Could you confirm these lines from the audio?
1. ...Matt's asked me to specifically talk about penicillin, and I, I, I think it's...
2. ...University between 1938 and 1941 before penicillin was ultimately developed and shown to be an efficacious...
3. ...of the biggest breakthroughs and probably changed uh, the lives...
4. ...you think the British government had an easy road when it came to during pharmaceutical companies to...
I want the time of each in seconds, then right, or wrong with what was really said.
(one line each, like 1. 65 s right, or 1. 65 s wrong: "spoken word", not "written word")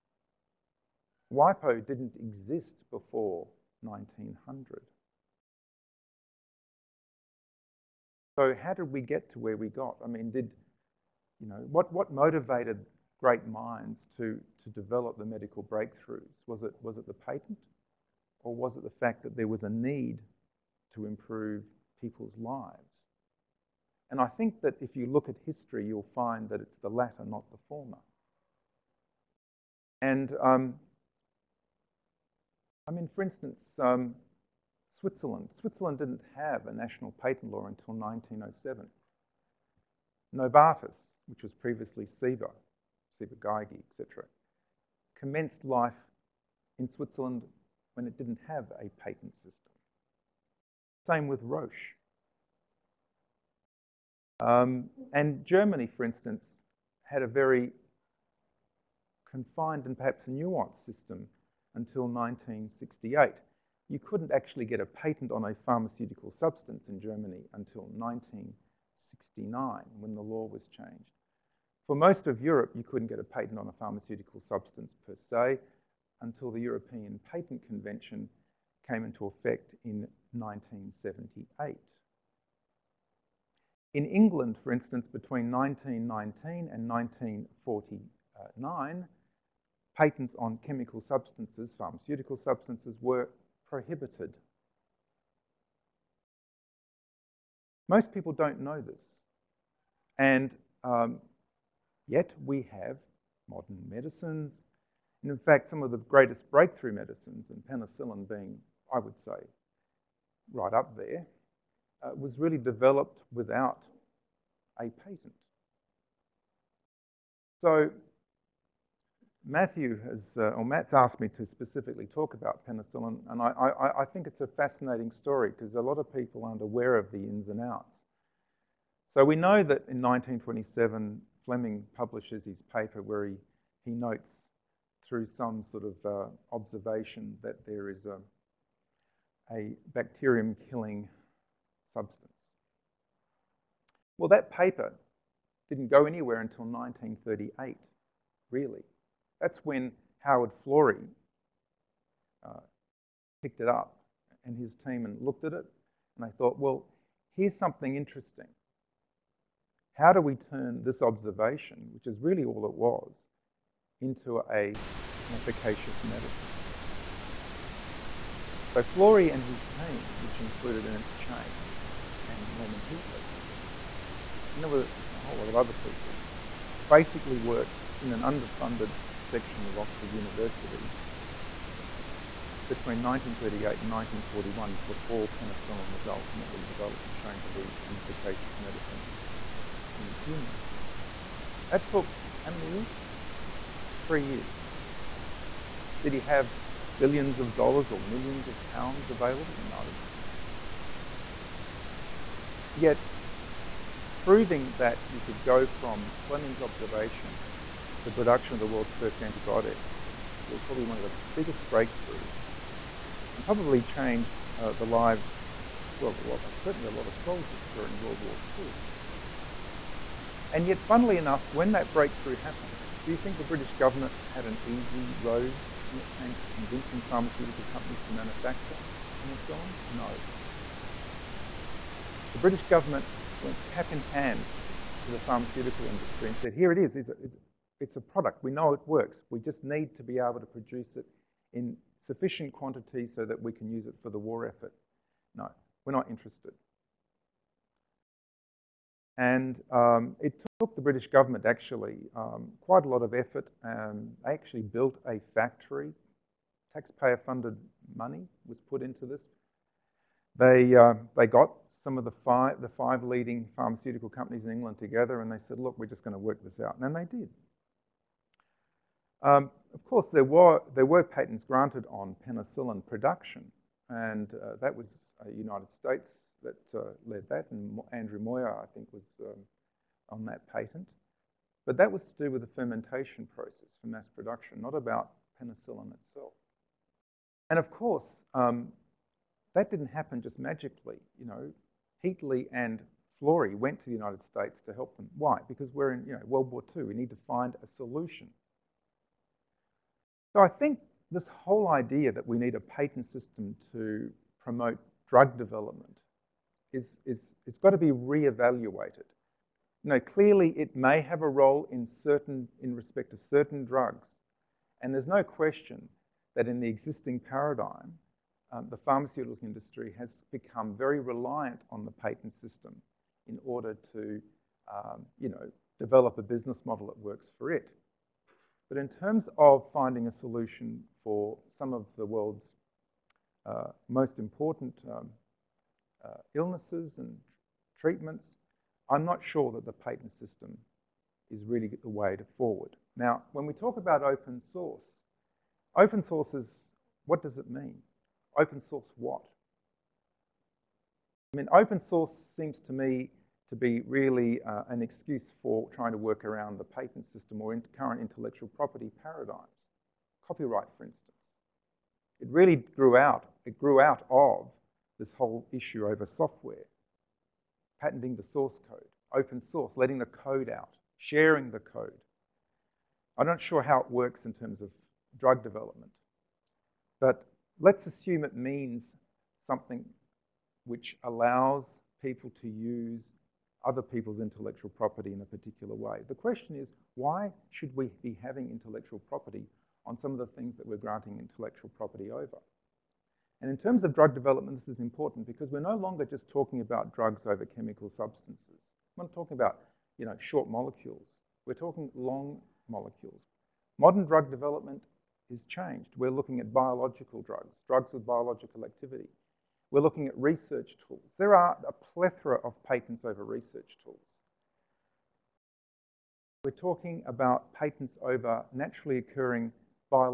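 1. 120 s right
2. 180 s right
3. 210 s right
4. 223 s wrong: "convincing", not "during".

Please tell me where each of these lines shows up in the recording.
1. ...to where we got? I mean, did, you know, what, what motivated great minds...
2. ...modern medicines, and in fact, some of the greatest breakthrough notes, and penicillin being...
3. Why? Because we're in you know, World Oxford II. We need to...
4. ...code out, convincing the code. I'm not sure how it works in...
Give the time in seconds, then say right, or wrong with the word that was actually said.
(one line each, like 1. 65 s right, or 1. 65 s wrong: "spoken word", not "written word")
1. 9 s right
2. 103 s wrong: "medicines", not "notes"
3. 295 s wrong: "War", not "Oxford"
4. 370 s wrong: "sharing", not "convincing".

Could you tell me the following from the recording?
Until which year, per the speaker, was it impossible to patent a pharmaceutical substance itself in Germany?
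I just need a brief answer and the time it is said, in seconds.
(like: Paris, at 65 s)
1969, at 67 s.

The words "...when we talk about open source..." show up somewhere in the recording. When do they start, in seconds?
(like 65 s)
343 s.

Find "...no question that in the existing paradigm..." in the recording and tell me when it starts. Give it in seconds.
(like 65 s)
315 s.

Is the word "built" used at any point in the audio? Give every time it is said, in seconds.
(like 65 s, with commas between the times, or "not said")
254 s.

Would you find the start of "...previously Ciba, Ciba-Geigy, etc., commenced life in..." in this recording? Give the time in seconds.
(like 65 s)
41 s.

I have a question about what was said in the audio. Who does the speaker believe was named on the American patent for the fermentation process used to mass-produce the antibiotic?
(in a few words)
Andrew Moyer.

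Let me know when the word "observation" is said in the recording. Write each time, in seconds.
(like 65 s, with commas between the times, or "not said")
136 s, 161 s, 206 s.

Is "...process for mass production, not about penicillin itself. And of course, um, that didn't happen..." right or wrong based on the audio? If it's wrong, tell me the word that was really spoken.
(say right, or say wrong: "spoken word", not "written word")
right.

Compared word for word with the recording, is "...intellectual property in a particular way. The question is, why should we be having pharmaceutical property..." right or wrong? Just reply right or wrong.
wrong.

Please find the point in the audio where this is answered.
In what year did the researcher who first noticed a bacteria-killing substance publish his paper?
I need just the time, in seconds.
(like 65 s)
130 s.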